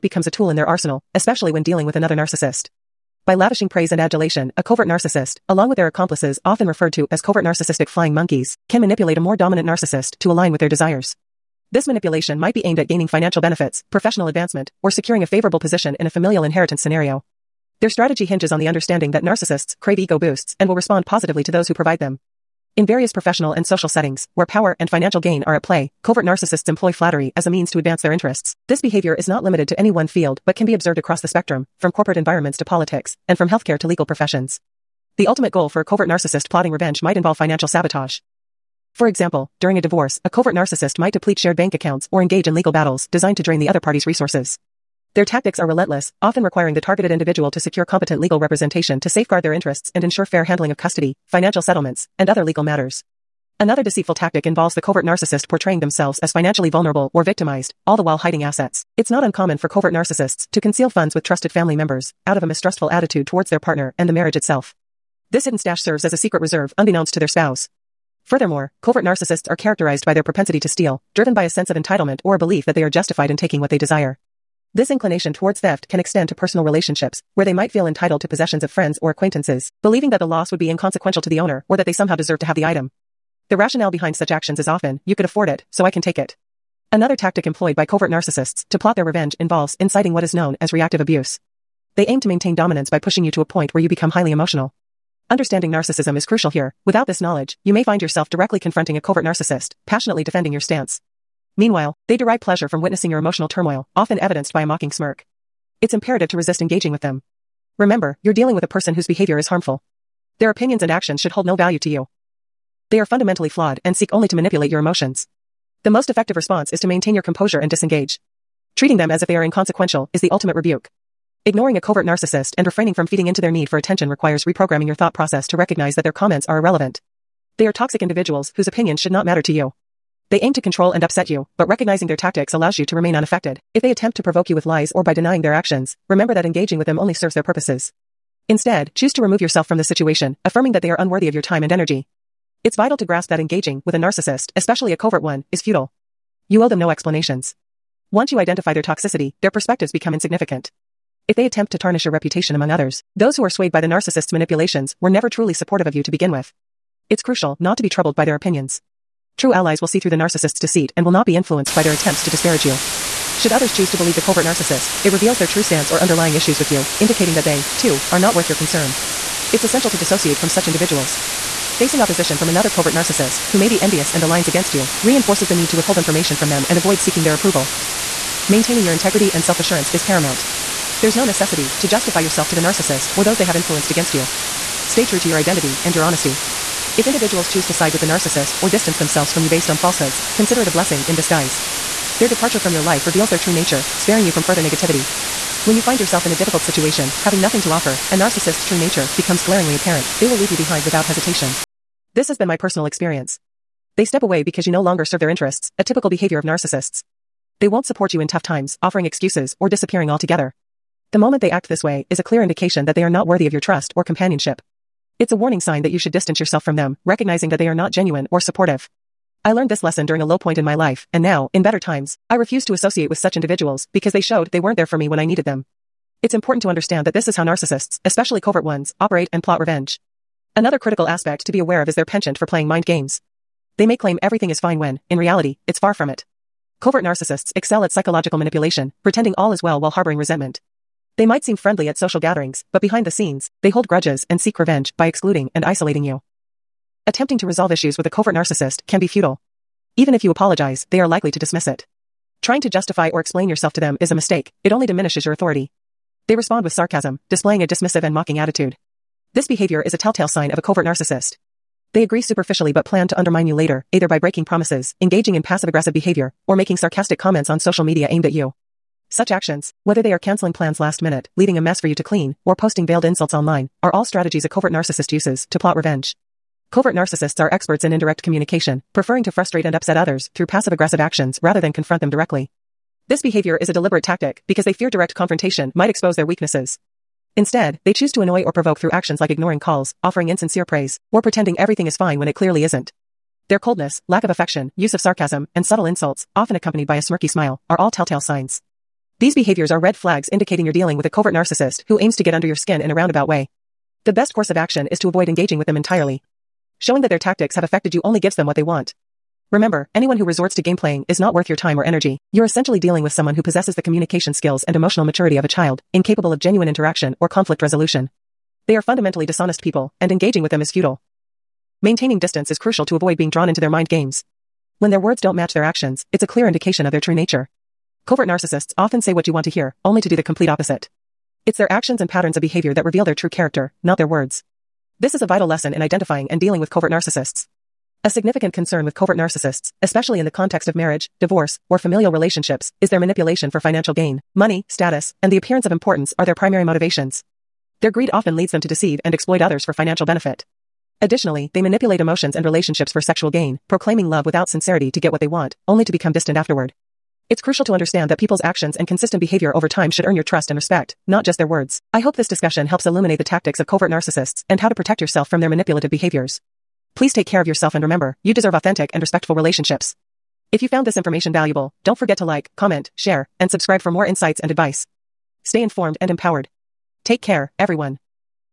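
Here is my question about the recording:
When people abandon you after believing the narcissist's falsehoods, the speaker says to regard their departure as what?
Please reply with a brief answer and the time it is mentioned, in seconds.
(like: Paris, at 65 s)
a blessing in disguise, at 190 s.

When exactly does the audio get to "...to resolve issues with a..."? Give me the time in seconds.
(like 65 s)
247 s.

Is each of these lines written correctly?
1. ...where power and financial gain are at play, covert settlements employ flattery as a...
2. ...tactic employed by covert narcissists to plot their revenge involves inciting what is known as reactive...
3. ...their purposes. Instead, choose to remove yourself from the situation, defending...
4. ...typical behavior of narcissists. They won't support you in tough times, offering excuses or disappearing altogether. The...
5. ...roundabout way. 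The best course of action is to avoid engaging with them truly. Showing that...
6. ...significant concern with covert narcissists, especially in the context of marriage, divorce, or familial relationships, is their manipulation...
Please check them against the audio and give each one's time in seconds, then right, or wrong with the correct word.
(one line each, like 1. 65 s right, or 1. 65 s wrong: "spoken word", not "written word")
1. 24 s wrong: "narcissists", not "settlements"
2. 87 s right
3. 137 s wrong: "affirming", not "defending"
4. 205 s right
5. 302 s wrong: "entirely", not "truly"
6. 338 s right.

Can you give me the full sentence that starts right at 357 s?
It's crucial to understand that people's actions and consistent behavior over time should earn your trust and respect, not just their words.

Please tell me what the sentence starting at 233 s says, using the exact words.
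They may claim everything is fine when, in reality, it's far from it.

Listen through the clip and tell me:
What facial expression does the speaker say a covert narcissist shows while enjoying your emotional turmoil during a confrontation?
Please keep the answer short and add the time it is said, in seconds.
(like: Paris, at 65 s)
a mocking smirk, at 104 s.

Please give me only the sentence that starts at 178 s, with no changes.
Maintaining your integrity and self-assurance is paramount.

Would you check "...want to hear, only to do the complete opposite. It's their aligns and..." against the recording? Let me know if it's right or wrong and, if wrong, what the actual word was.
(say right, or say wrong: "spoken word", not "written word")
wrong: "actions", not "aligns".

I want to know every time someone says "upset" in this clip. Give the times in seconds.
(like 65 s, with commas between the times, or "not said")
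131 s, 279 s.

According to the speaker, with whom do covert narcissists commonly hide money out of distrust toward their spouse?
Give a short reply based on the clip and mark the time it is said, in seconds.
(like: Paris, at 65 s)
trusted family members, at 61 s.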